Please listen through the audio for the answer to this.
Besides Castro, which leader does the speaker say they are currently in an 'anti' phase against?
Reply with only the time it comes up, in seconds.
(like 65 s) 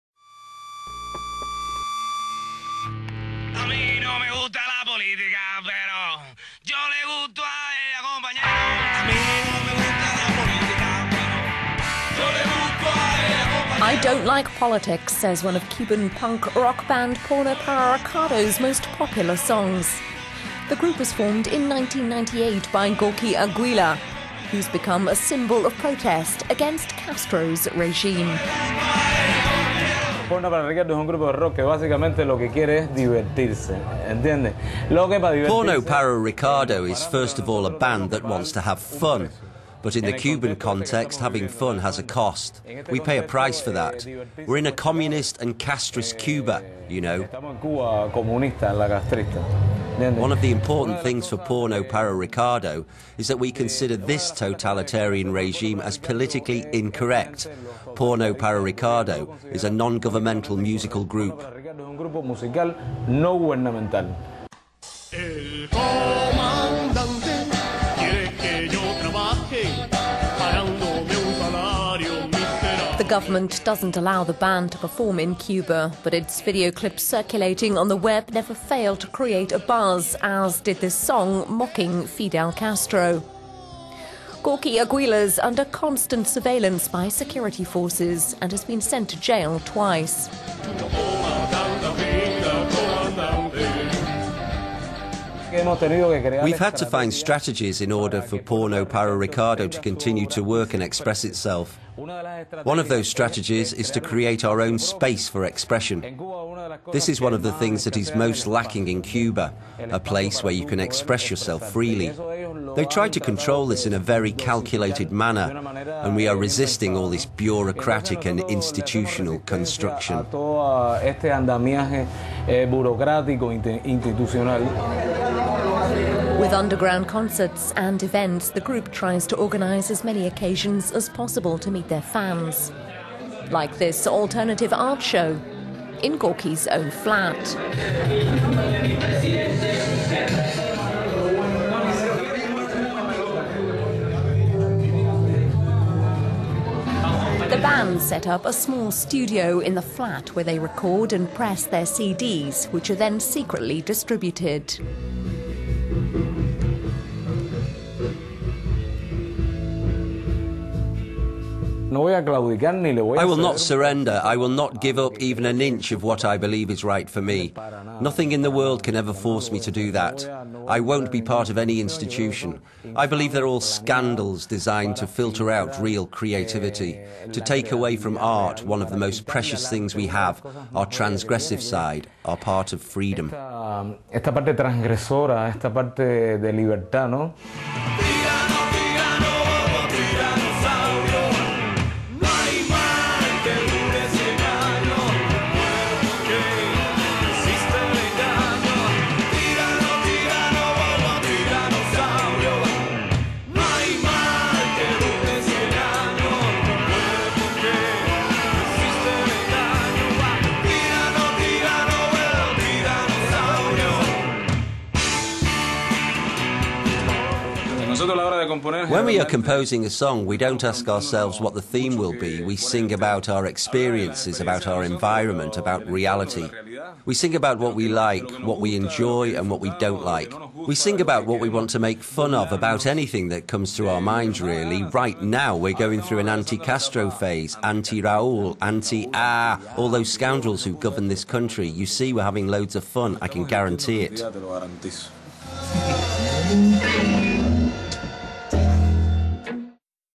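238 s.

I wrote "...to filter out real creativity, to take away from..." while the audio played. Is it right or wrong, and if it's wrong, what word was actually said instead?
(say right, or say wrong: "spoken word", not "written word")
right.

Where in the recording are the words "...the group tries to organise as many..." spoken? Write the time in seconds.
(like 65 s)
128 s.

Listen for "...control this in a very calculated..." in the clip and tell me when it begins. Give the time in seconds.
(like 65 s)
113 s.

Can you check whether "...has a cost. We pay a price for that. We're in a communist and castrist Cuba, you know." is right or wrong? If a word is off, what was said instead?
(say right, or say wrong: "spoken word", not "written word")
right.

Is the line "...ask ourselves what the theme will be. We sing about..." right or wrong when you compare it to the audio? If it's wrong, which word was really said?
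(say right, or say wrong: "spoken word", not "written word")
right.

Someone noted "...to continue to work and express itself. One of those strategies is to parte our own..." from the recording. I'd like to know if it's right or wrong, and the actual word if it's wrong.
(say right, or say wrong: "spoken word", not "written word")
wrong: "create", not "parte".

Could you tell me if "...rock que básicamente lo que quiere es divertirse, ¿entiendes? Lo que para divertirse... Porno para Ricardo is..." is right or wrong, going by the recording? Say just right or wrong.
right.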